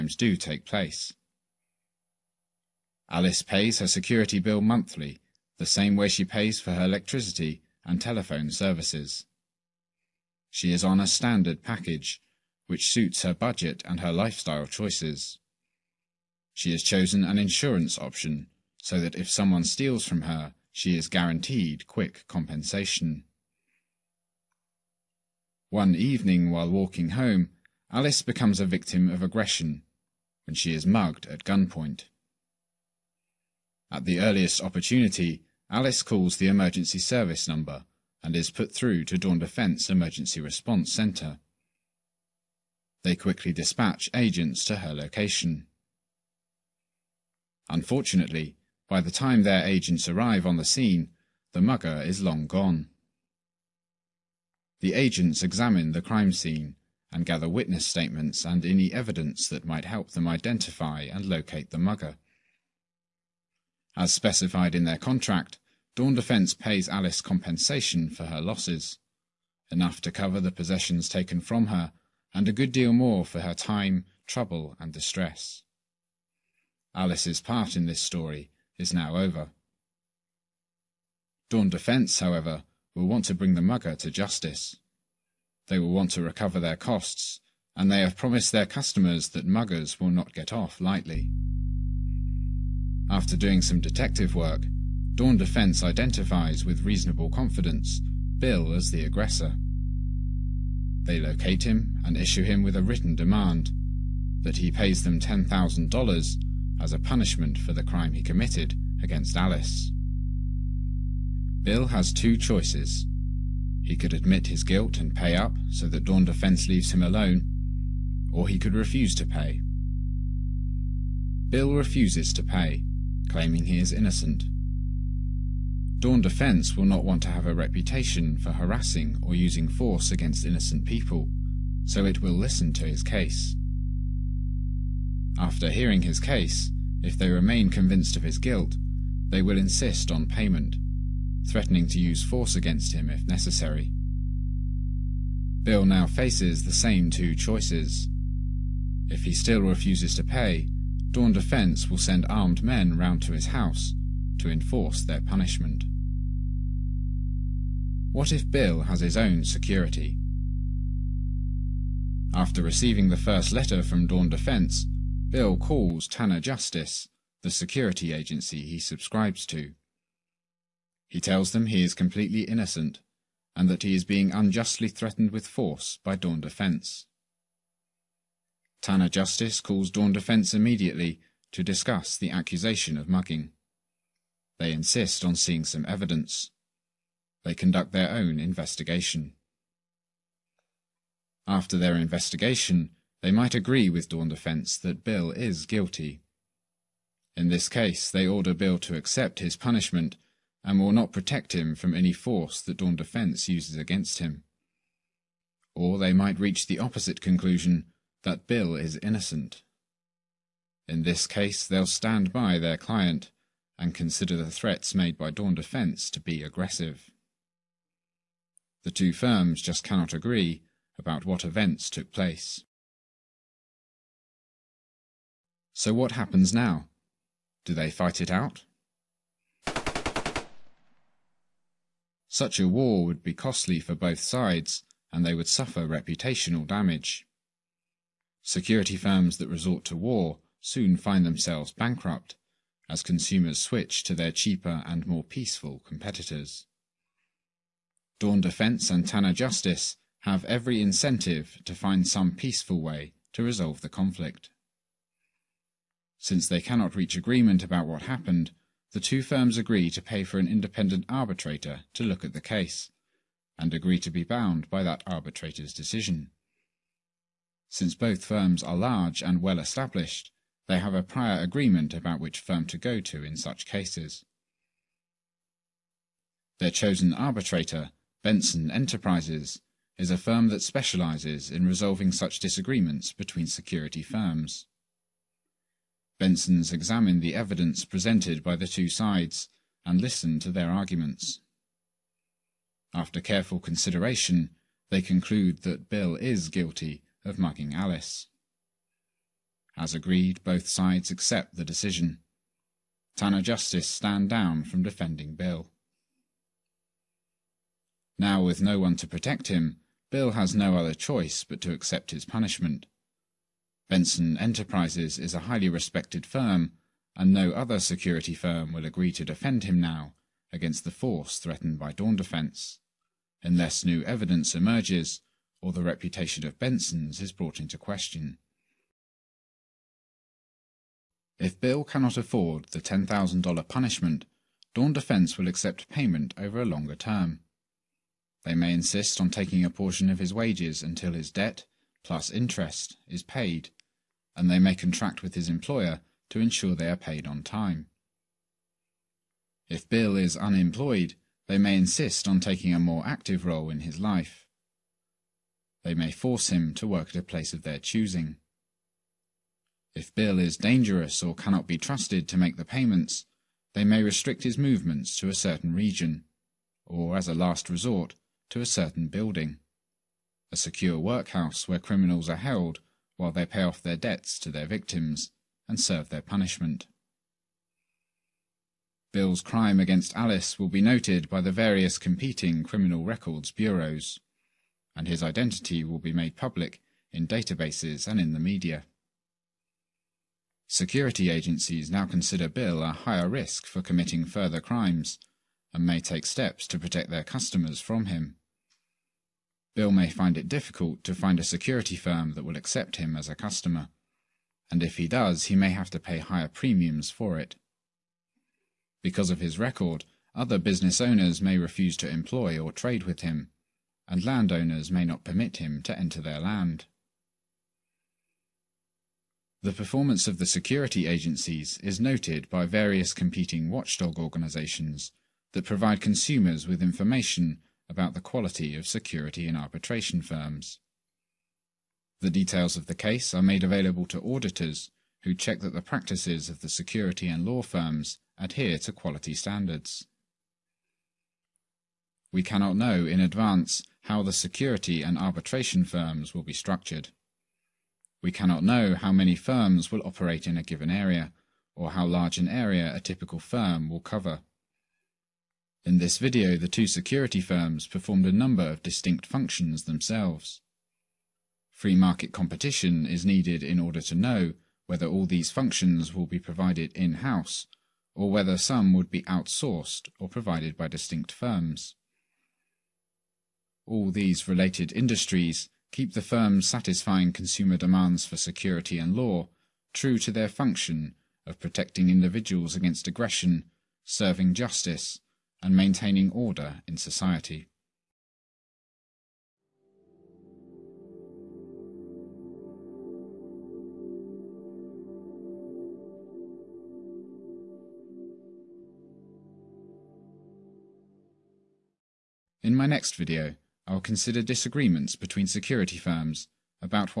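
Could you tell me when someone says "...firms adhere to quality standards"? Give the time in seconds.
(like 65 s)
437 s.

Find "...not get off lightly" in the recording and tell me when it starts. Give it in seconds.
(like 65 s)
90 s.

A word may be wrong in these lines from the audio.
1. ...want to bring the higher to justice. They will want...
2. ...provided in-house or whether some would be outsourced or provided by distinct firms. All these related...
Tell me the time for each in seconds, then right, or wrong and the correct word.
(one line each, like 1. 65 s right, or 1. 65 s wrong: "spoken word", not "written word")
1. 83 s wrong: "mugger", not "higher"
2. 466 s right.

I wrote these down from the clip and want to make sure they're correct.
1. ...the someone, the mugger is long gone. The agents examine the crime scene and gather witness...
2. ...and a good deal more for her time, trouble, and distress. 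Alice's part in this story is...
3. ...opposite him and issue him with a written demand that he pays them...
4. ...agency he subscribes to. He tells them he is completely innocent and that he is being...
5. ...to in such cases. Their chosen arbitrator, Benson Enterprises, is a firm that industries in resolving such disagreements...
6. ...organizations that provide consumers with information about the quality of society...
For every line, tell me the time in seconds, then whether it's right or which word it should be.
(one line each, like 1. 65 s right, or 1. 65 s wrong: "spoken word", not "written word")
1. 50 s wrong: "scene", not "someone"
2. 72 s right
3. 101 s wrong: "locate", not "opposite"
4. 168 s right
5. 273 s wrong: "specializes", not "industries"
6. 424 s wrong: "security", not "society".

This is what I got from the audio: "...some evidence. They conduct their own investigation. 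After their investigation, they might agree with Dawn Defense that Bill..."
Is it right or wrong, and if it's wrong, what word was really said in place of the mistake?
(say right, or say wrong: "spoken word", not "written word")
right.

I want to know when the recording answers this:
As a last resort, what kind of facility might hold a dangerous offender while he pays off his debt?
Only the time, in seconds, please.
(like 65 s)
370 s.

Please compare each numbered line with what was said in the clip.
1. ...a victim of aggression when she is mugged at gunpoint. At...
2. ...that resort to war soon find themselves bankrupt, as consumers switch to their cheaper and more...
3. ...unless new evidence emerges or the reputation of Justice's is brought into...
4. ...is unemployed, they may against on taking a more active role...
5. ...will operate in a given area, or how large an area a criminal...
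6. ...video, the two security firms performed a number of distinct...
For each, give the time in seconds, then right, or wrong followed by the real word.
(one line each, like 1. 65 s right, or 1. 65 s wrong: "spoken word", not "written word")
1. 28 s right
2. 239 s right
3. 323 s wrong: "Benson", not "Justice"
4. 350 s wrong: "insist", not "against"
5. 449 s wrong: "typical", not "criminal"
6. 456 s right.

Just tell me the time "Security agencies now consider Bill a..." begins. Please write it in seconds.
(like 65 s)
390 s.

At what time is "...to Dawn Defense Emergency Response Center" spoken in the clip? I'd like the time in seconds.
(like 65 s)
39 s.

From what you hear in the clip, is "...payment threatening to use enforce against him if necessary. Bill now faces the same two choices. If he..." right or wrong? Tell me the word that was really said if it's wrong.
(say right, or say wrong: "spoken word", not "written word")
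wrong: "force", not "enforce".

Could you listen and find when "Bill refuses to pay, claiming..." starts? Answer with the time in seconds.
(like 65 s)
121 s.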